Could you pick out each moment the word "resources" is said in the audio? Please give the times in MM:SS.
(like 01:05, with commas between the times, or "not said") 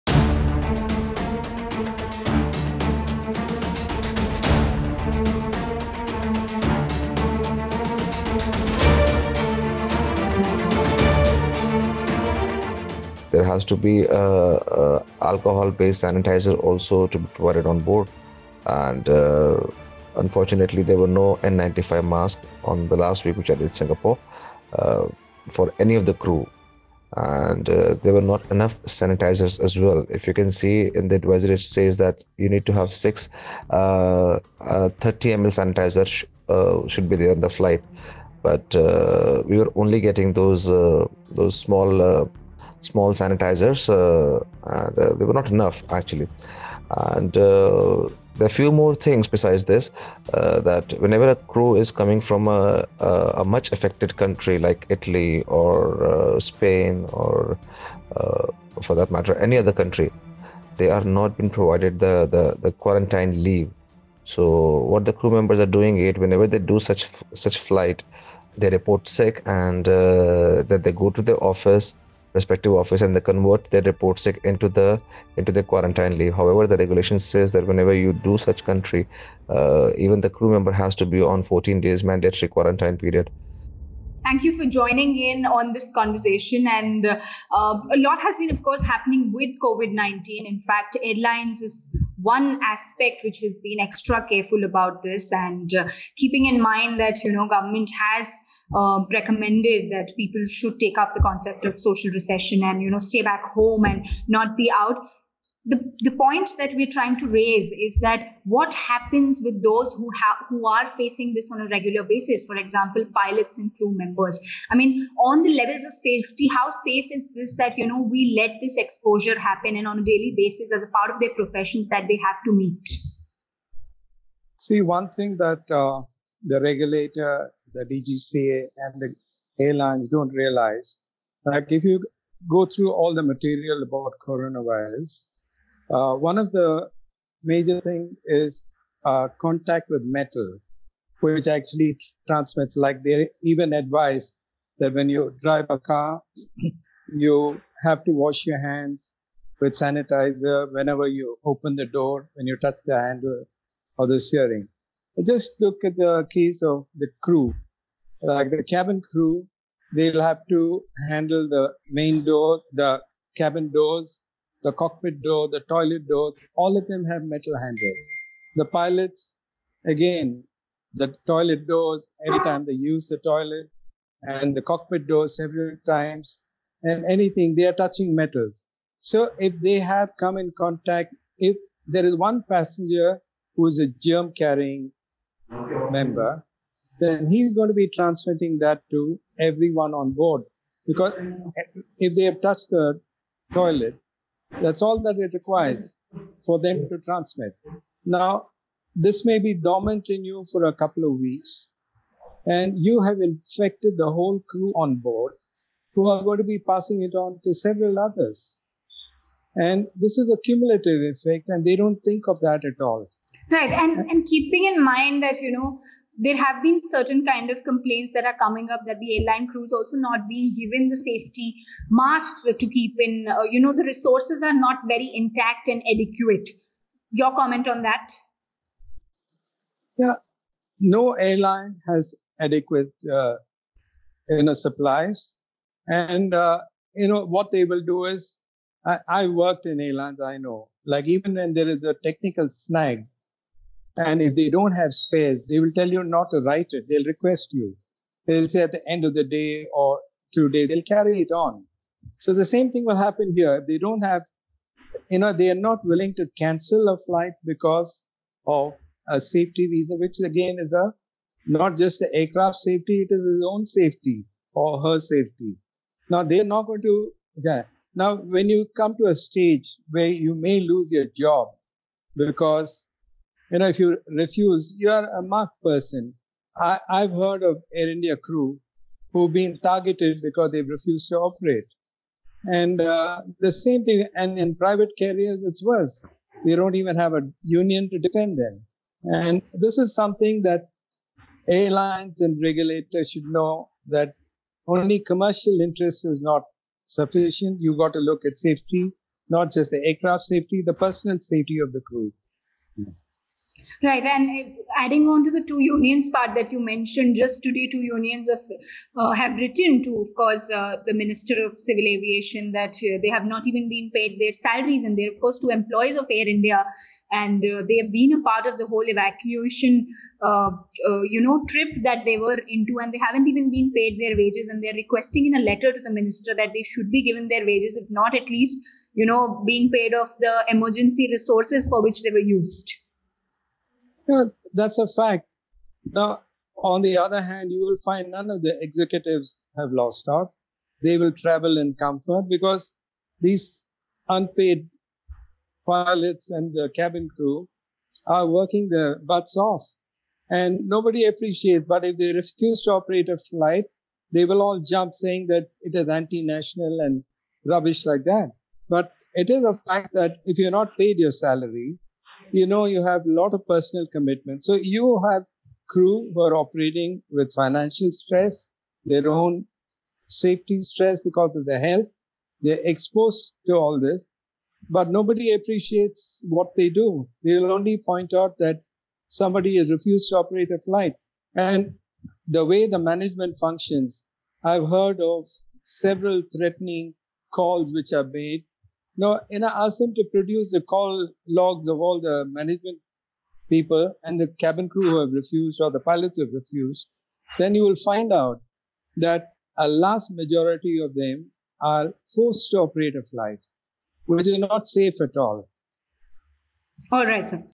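03:43, 05:31.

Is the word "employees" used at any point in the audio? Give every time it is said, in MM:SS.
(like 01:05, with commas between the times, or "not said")
05:15.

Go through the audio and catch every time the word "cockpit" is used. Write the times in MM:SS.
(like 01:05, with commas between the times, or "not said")
02:44, 02:54.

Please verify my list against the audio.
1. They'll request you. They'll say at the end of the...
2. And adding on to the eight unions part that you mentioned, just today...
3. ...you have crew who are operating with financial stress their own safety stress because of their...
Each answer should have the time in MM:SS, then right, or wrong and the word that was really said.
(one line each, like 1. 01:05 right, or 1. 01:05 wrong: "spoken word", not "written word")
1. 04:06 right
2. 05:04 wrong: "two", not "eight"
3. 06:04 right.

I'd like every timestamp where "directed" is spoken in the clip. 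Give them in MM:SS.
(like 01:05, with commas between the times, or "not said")
not said.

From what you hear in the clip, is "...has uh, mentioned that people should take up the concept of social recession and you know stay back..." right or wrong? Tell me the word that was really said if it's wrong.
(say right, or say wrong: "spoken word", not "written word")
wrong: "recommended", not "mentioned".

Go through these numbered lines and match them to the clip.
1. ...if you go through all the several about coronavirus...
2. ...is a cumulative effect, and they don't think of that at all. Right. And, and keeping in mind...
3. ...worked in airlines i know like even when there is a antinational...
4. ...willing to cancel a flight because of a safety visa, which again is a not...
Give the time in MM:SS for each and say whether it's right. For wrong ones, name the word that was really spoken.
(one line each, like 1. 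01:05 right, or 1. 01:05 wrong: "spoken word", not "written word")
1. 02:11 wrong: "material", not "several"
2. 03:30 right
3. 03:59 wrong: "technical", not "antinational"
4. 04:15 right.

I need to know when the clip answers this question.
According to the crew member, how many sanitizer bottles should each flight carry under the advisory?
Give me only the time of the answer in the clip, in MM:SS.
00:32.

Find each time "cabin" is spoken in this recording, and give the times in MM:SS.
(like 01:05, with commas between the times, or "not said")
02:38, 02:43, 05:46, 06:34.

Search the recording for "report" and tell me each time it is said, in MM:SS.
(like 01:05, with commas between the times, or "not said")
01:08, 01:13.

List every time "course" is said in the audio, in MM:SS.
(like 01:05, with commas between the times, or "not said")
01:28, 05:10, 05:15.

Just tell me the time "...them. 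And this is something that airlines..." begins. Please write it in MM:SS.
04:48.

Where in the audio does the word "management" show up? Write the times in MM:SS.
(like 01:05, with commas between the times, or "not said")
06:22, 06:32.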